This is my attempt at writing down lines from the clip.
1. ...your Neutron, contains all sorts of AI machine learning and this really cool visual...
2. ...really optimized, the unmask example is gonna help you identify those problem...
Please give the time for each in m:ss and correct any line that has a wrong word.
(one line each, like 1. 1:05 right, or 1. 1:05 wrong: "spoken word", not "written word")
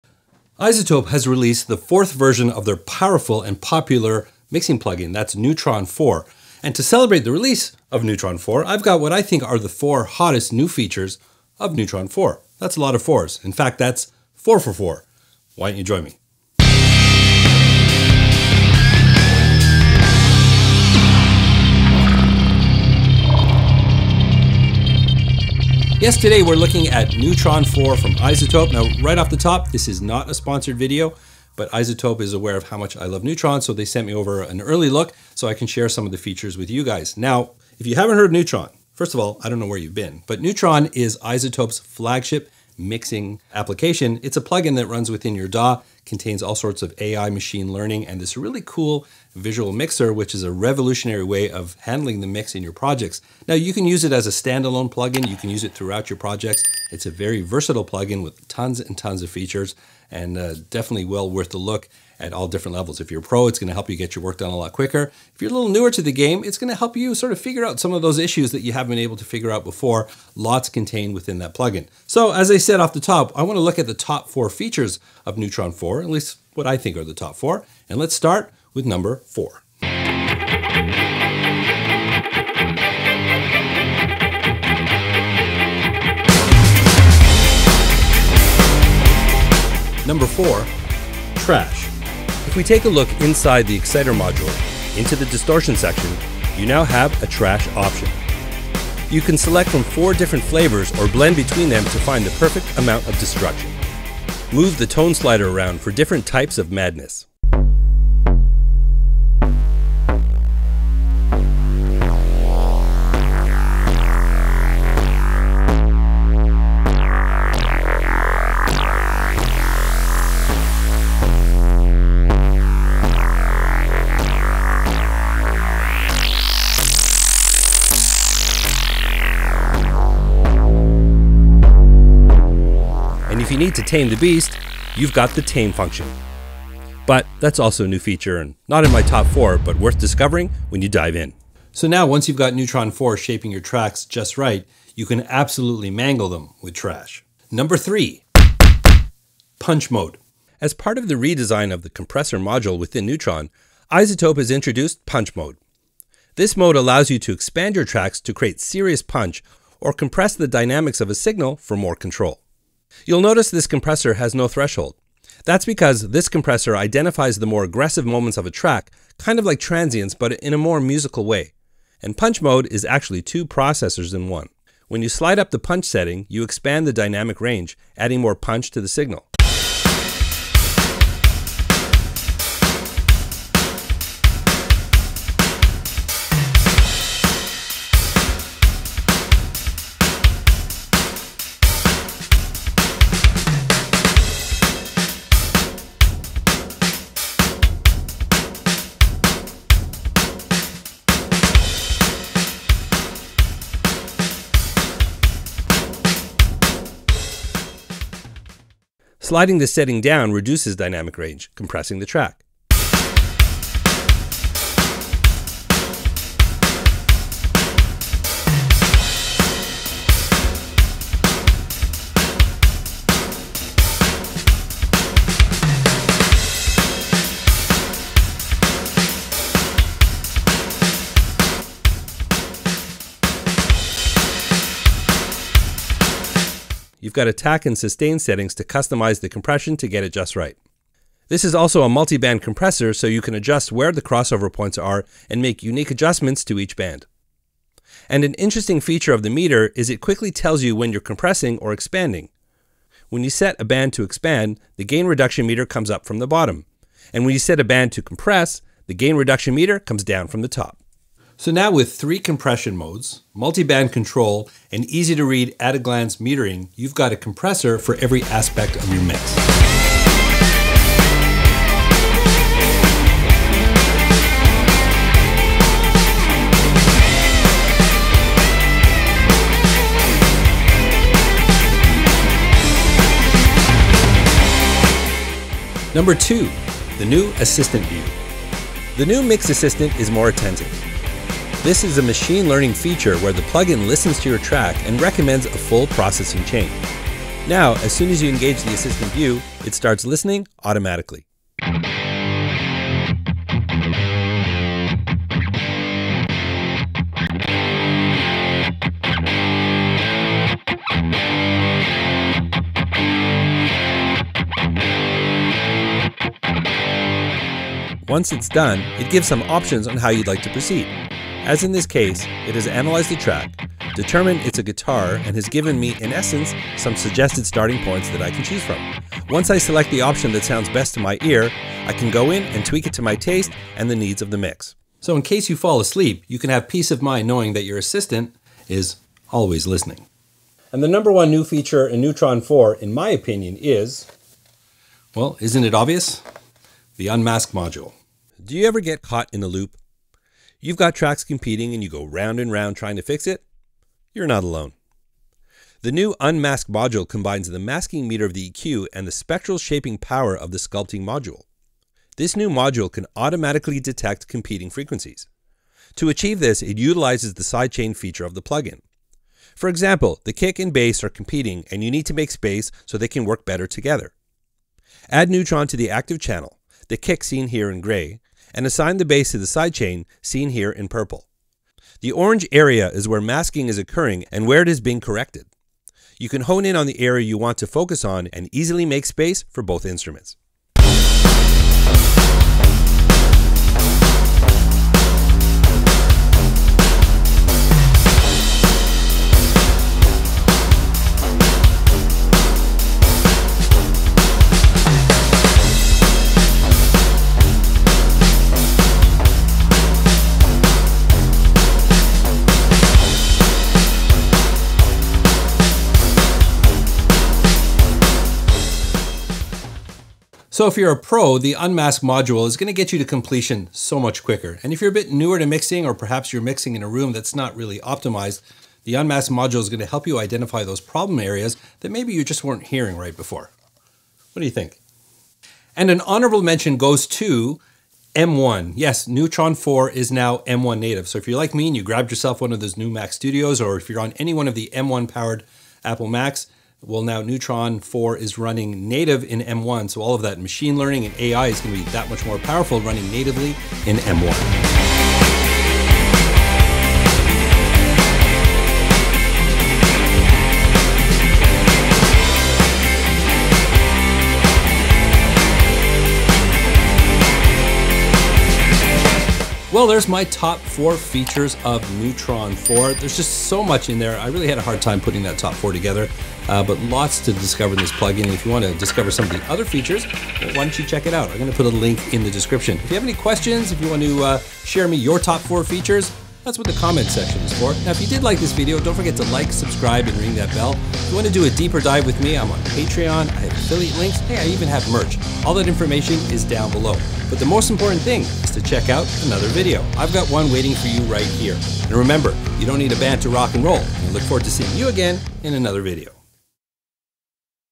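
1. 0:45 wrong: "DAW", not "Neutron"
2. 7:07 wrong: "module", not "example".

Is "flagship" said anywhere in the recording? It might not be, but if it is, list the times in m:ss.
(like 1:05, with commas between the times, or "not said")
0:41.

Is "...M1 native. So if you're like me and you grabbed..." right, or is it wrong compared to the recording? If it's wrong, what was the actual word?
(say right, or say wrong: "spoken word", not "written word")
right.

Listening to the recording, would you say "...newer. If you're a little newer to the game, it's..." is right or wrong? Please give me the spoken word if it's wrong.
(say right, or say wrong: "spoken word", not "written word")
wrong: "quicker", not "newer".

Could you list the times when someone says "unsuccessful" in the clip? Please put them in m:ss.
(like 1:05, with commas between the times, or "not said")
not said.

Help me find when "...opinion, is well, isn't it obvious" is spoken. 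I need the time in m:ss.
5:43.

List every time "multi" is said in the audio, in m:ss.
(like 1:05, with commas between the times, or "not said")
4:01, 4:23.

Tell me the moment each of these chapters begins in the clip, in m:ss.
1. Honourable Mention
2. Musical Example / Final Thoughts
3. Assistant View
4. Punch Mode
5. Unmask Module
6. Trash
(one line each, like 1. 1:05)
1. 7:14
2. 7:34
3. 4:45
4. 2:26
5. 5:40
6. 1:19.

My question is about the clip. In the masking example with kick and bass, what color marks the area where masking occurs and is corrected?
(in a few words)
orange.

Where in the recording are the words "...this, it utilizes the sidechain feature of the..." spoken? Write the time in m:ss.
6:06.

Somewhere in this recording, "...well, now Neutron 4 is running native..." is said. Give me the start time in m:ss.
7:26.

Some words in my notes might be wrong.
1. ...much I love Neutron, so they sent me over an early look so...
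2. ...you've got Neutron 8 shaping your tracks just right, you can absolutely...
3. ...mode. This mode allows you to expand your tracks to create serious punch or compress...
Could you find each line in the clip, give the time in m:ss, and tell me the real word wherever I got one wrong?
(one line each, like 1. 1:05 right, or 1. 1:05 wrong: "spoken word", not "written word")
1. 0:32 right
2. 2:22 wrong: "4", not "8"
3. 2:35 right.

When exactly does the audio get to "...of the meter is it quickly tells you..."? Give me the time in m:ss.
4:09.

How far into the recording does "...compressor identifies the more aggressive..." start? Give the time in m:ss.
2:46.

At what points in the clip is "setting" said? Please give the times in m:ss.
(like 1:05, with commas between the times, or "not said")
2:55, 3:29, 3:58.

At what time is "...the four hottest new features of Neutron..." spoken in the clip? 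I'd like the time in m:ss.
0:09.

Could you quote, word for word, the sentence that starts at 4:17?
And when you set a band to compress, the gain reduction meter comes down from the top.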